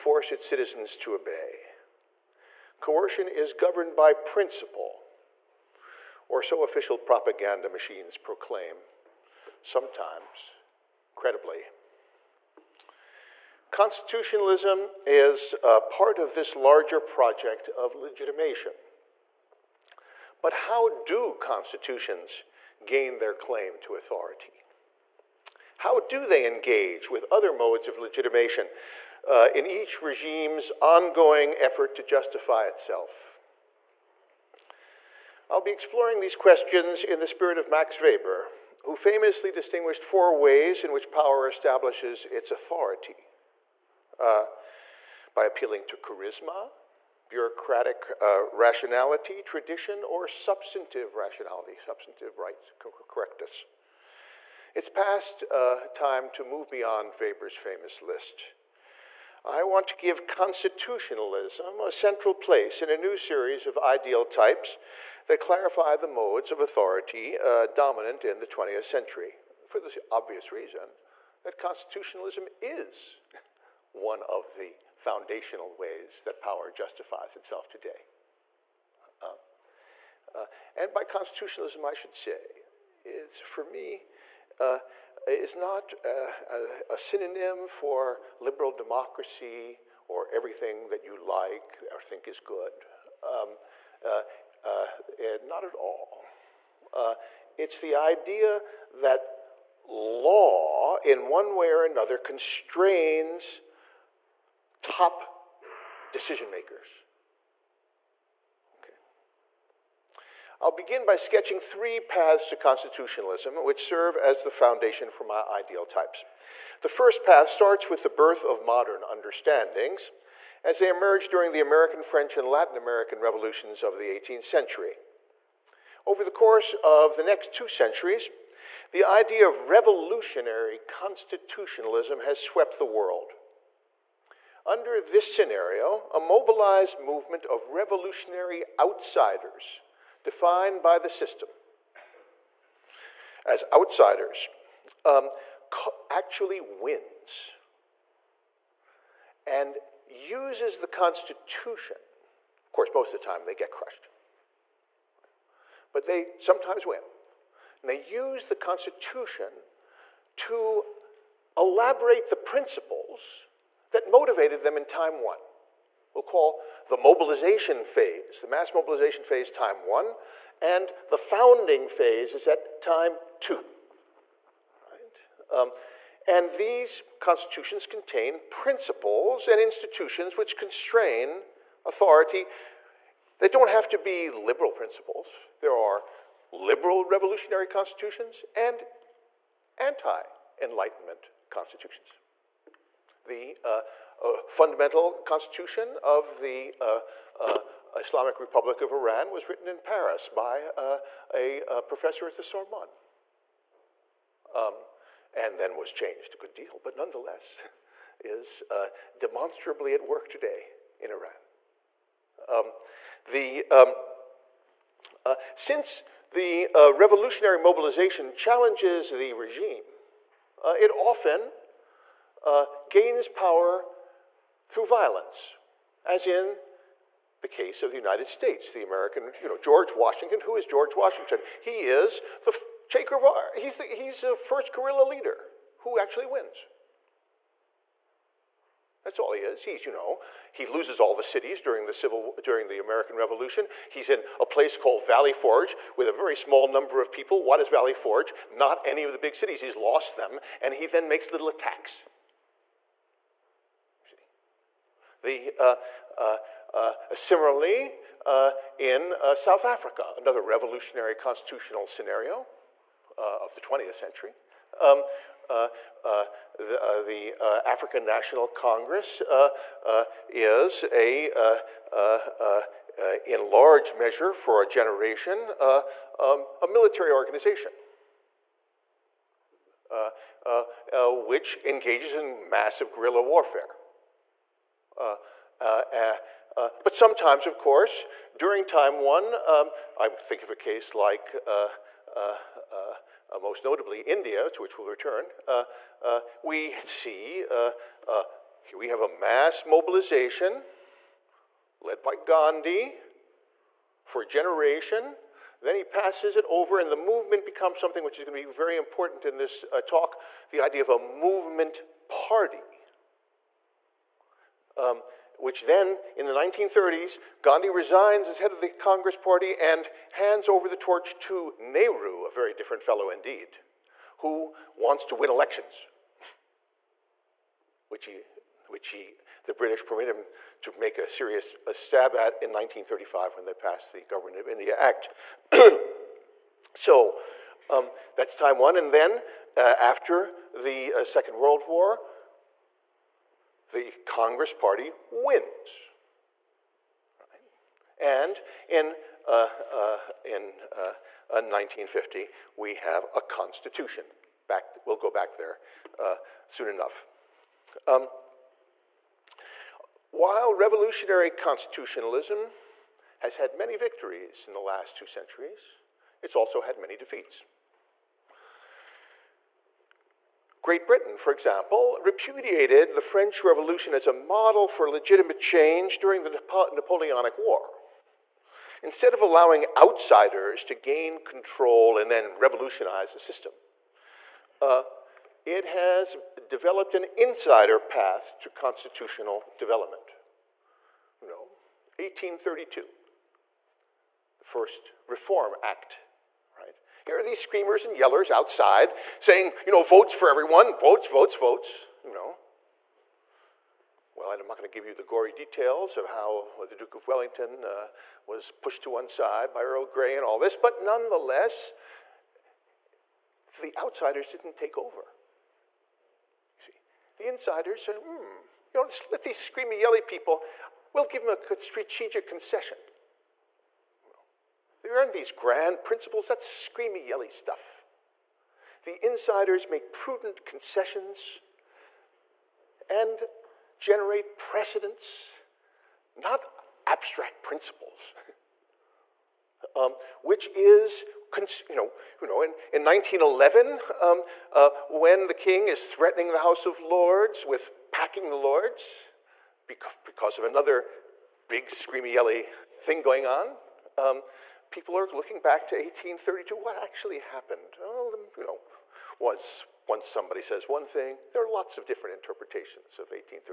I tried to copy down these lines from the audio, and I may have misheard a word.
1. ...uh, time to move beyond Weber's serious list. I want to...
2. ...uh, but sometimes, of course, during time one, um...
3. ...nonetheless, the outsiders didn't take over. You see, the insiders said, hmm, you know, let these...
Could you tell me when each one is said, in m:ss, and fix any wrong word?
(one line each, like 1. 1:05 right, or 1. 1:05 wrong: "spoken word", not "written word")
1. 0:55 wrong: "famous", not "serious"
2. 4:46 right
3. 6:50 right.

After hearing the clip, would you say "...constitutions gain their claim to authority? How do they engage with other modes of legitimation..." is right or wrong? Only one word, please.
right.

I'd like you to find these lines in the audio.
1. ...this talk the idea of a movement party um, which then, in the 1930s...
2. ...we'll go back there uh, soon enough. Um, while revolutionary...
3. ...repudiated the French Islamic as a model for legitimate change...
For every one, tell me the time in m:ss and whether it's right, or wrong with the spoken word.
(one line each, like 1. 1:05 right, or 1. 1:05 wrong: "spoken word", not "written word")
1. 5:09 right
2. 5:54 right
3. 6:12 wrong: "Revolution", not "Islamic".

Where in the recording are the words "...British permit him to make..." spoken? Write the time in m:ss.
5:29.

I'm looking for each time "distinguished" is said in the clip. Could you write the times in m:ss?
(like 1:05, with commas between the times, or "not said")
0:39.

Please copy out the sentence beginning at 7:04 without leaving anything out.
We learn these grand principles, that's screamy, yelly stuff.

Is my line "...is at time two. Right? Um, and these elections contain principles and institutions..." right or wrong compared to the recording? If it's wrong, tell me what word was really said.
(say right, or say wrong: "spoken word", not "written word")
wrong: "constitutions", not "elections".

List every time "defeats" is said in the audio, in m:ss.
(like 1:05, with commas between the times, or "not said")
6:06.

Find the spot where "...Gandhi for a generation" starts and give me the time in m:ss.
5:02.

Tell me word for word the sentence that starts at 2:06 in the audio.
Over the course of the next two centuries, the idea of revolutionary constitutionalism has swept the world.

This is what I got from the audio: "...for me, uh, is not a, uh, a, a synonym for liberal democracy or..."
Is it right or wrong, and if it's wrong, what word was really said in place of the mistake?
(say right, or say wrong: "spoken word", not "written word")
right.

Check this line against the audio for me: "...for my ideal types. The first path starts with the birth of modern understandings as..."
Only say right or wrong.
right.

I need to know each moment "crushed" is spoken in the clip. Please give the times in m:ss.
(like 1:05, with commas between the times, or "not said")
2:33.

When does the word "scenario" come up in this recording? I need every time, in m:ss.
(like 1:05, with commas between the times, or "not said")
2:15, 4:21.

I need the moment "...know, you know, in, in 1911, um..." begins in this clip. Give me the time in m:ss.
7:21.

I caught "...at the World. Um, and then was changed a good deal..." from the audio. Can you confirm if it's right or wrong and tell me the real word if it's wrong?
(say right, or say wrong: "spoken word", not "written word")
wrong: "Sorbonne", not "World".